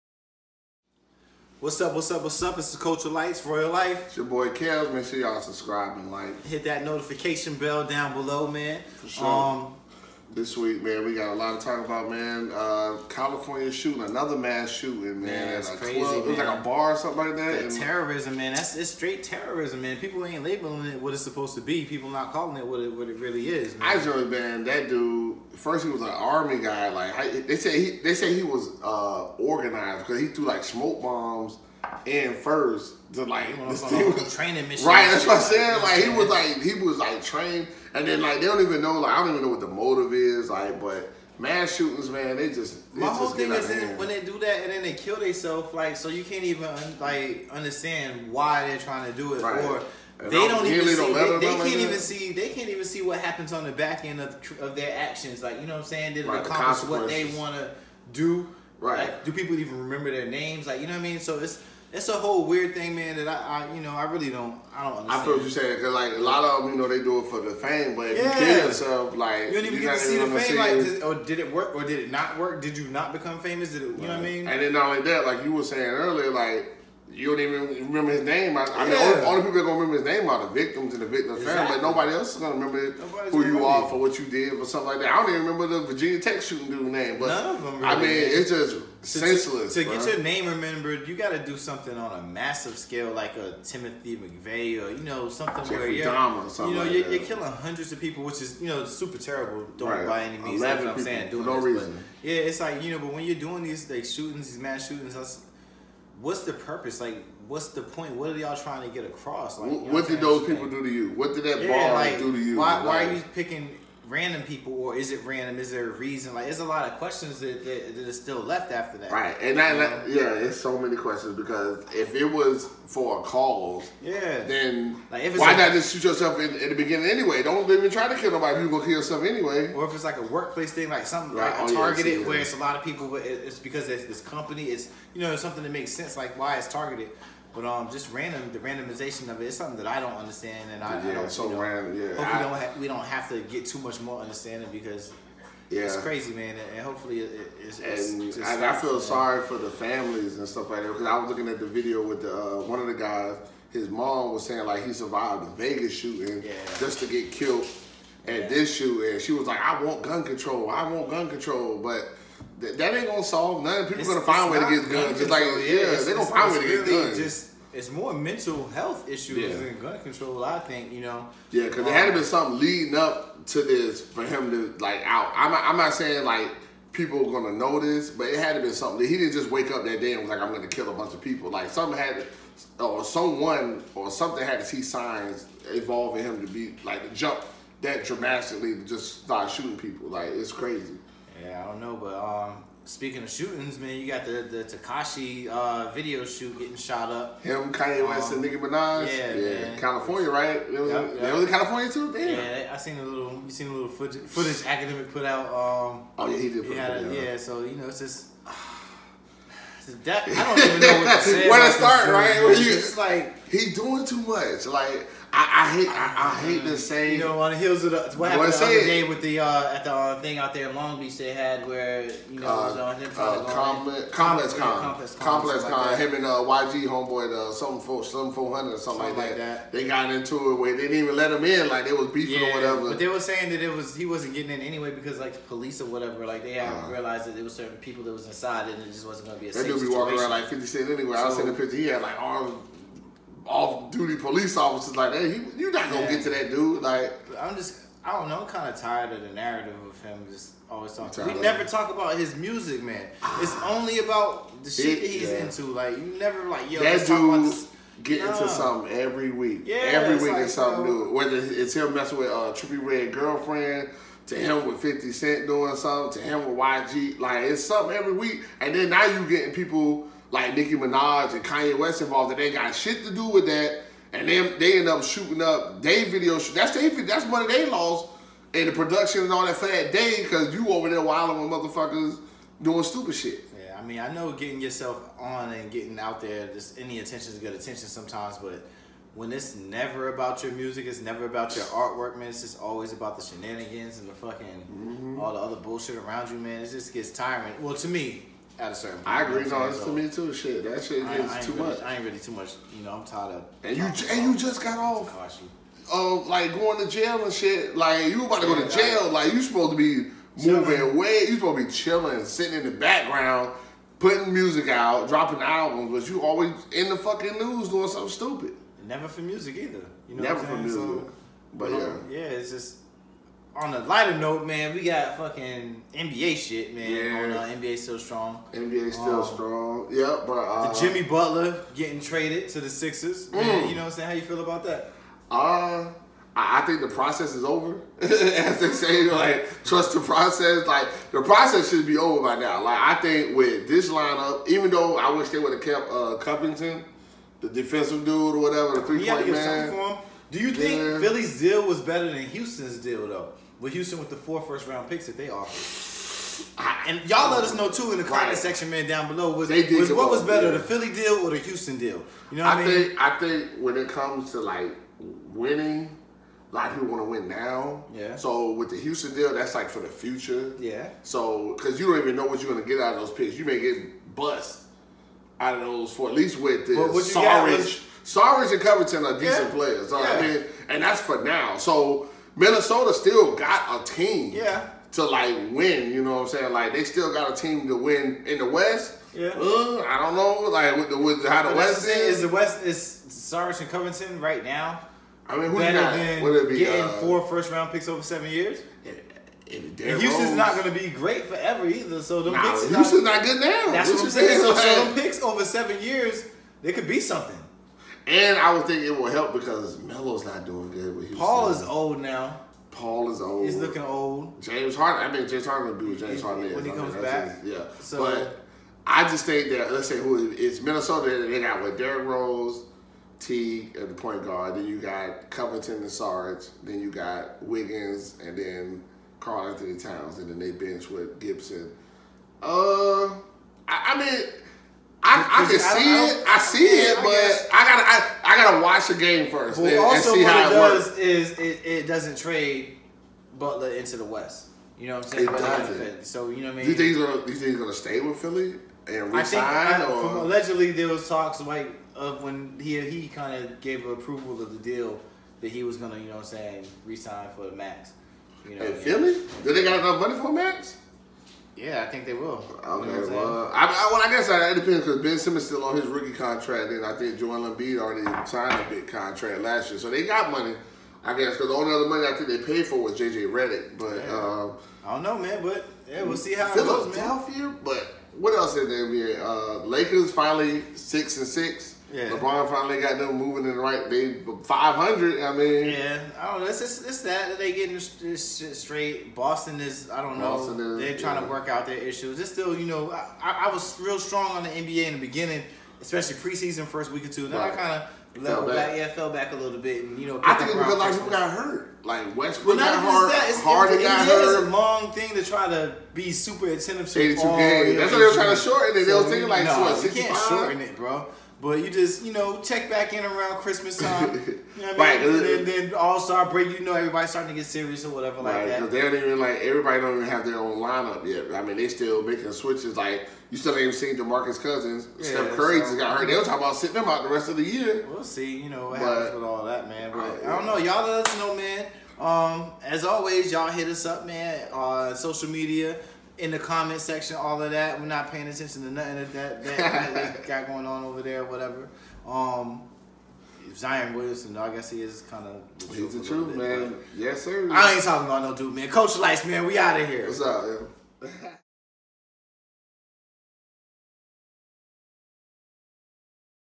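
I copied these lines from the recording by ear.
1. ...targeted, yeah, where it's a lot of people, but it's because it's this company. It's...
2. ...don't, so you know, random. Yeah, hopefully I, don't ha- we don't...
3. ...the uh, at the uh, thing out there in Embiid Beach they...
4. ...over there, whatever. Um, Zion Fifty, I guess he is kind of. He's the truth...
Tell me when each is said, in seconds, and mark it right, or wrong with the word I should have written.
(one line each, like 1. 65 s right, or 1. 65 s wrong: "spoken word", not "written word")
1. 131 s right
2. 141 s right
3. 219 s wrong: "Long", not "Embiid"
4. 540 s wrong: "Williamson", not "Fifty".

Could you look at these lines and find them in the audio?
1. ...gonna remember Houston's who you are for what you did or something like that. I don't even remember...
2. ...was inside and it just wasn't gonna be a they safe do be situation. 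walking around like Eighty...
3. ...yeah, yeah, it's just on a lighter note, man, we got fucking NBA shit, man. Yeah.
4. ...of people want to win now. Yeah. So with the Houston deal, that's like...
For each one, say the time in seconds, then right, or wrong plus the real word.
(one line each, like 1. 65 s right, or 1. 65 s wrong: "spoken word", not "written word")
1. 82 s wrong: "Nobody", not "Houston"
2. 238 s wrong: "Fifty", not "Eighty"
3. 321 s right
4. 366 s right.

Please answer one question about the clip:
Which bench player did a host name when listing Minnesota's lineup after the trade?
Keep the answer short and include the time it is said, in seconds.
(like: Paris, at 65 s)
Gibson, at 431 s.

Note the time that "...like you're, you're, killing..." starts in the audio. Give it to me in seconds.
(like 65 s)
96 s.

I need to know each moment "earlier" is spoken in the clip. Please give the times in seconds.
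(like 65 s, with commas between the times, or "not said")
75 s.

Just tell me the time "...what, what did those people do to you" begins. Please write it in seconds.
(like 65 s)
109 s.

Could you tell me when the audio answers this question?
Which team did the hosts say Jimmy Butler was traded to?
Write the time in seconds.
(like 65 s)
332 s.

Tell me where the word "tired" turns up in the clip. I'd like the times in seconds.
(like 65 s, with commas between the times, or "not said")
248 s, 303 s.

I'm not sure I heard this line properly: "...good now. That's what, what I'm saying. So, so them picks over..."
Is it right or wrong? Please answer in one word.
right.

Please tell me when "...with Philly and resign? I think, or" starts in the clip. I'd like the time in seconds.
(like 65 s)
448 s.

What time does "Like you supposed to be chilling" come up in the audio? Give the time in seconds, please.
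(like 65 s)
309 s.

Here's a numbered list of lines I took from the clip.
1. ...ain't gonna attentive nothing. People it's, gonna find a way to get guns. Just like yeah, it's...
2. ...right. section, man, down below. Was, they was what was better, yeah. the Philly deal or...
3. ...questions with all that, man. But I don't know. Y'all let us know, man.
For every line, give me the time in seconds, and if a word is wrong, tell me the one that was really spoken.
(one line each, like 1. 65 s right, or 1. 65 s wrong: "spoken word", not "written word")
1. 162 s wrong: "solve", not "attentive"
2. 358 s right
3. 528 s wrong: "happens", not "questions".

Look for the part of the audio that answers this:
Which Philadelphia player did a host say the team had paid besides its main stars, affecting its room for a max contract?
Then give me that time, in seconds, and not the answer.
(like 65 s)
472 s.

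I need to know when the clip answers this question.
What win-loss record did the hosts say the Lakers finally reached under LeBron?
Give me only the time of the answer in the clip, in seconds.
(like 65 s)
480 s.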